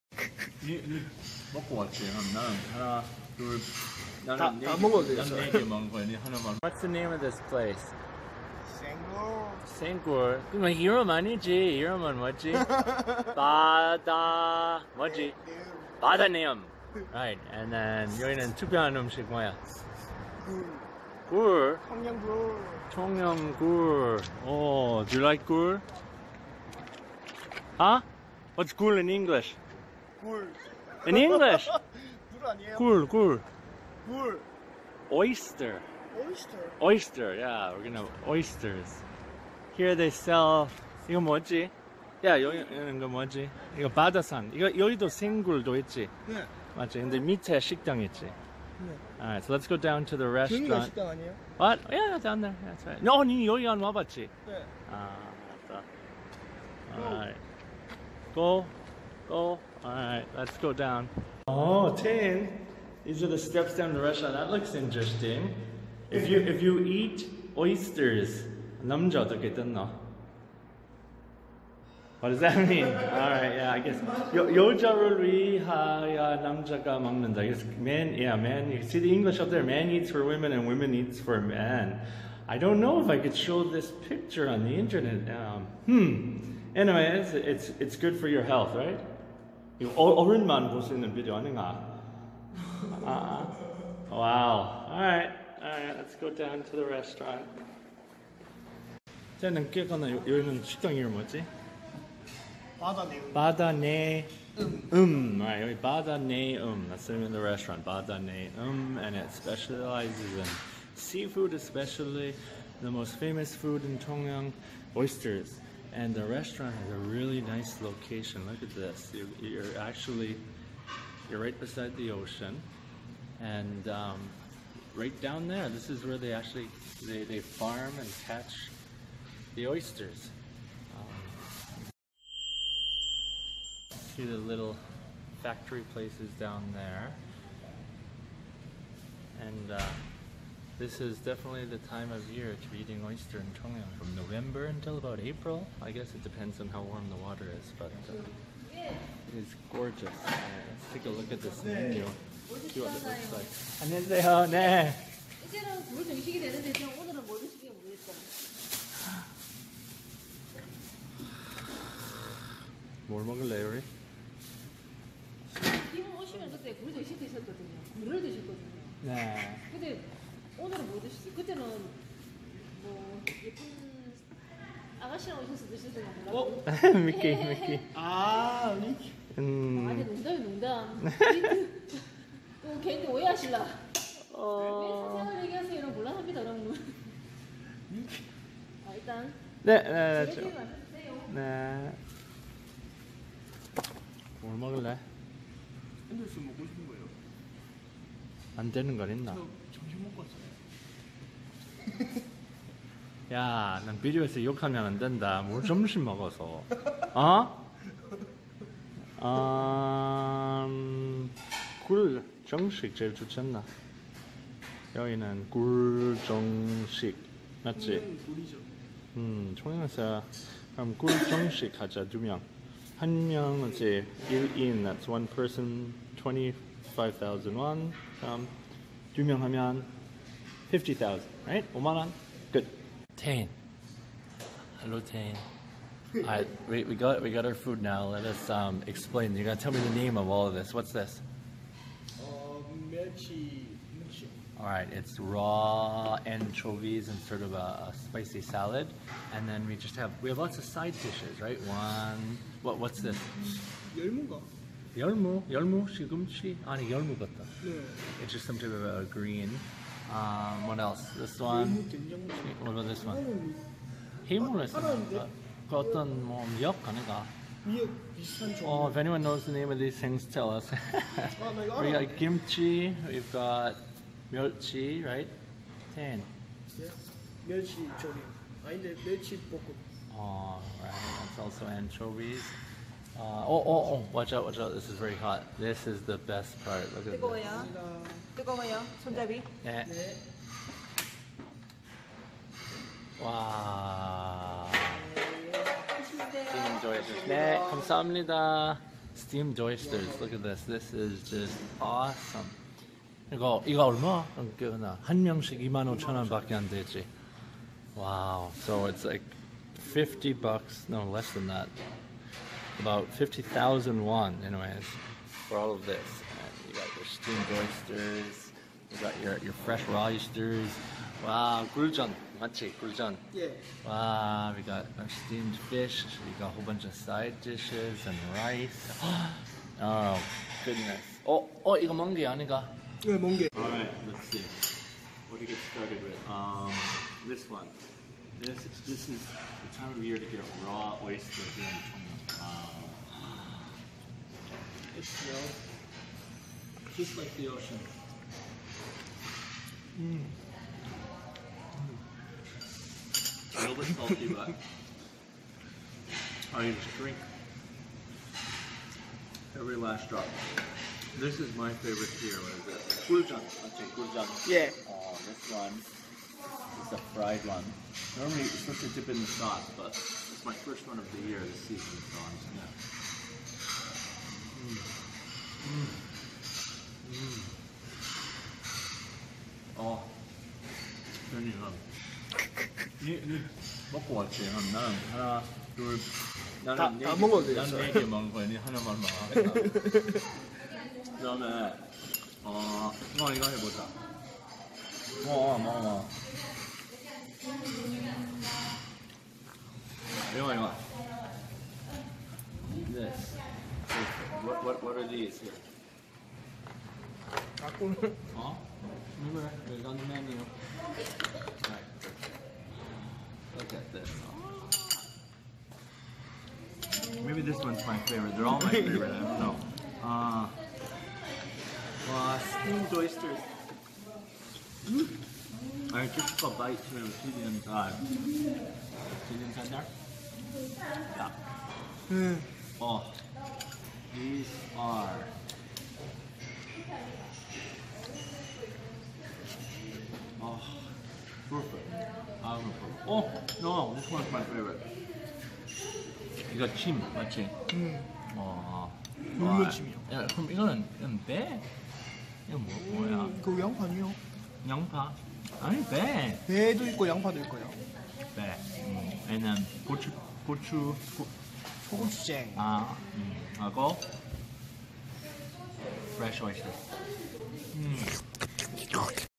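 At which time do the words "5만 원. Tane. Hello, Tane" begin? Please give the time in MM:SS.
03:51.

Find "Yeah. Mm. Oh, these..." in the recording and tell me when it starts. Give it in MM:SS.
07:11.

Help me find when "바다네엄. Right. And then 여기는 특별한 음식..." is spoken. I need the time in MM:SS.
00:15.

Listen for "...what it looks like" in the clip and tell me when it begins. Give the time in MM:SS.
02:32.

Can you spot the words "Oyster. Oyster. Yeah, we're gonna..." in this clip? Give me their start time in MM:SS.
00:36.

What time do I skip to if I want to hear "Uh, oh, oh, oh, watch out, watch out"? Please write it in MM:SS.
04:43.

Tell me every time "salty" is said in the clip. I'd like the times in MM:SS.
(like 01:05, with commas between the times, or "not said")
05:53.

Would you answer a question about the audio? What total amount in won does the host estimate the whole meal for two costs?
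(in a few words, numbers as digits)
50,000 won.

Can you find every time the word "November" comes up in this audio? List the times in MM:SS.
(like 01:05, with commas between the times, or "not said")
02:24.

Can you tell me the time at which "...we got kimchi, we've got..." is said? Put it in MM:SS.
04:31.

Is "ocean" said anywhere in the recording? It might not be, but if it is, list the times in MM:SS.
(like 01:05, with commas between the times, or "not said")
02:02, 05:47.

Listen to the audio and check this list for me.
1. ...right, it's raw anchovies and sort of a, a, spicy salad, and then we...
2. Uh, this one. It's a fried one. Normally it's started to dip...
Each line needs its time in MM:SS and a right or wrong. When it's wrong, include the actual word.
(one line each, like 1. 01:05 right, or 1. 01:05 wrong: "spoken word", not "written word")
1. 04:04 right
2. 06:04 wrong: "supposed", not "started".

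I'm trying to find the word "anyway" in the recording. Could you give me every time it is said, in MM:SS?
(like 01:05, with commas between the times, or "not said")
01:26, 05:14.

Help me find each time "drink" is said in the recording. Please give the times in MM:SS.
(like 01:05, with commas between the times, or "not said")
05:56.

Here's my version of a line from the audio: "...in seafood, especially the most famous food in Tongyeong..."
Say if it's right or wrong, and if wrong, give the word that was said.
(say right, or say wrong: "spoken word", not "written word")
right.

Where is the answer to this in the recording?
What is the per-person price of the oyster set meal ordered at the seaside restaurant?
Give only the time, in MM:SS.
03:44.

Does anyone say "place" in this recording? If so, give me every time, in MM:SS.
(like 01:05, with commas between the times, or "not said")
00:07, 02:15.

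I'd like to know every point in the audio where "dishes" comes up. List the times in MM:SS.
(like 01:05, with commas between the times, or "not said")
04:11, 05:27.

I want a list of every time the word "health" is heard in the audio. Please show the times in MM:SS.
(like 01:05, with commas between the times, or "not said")
01:28.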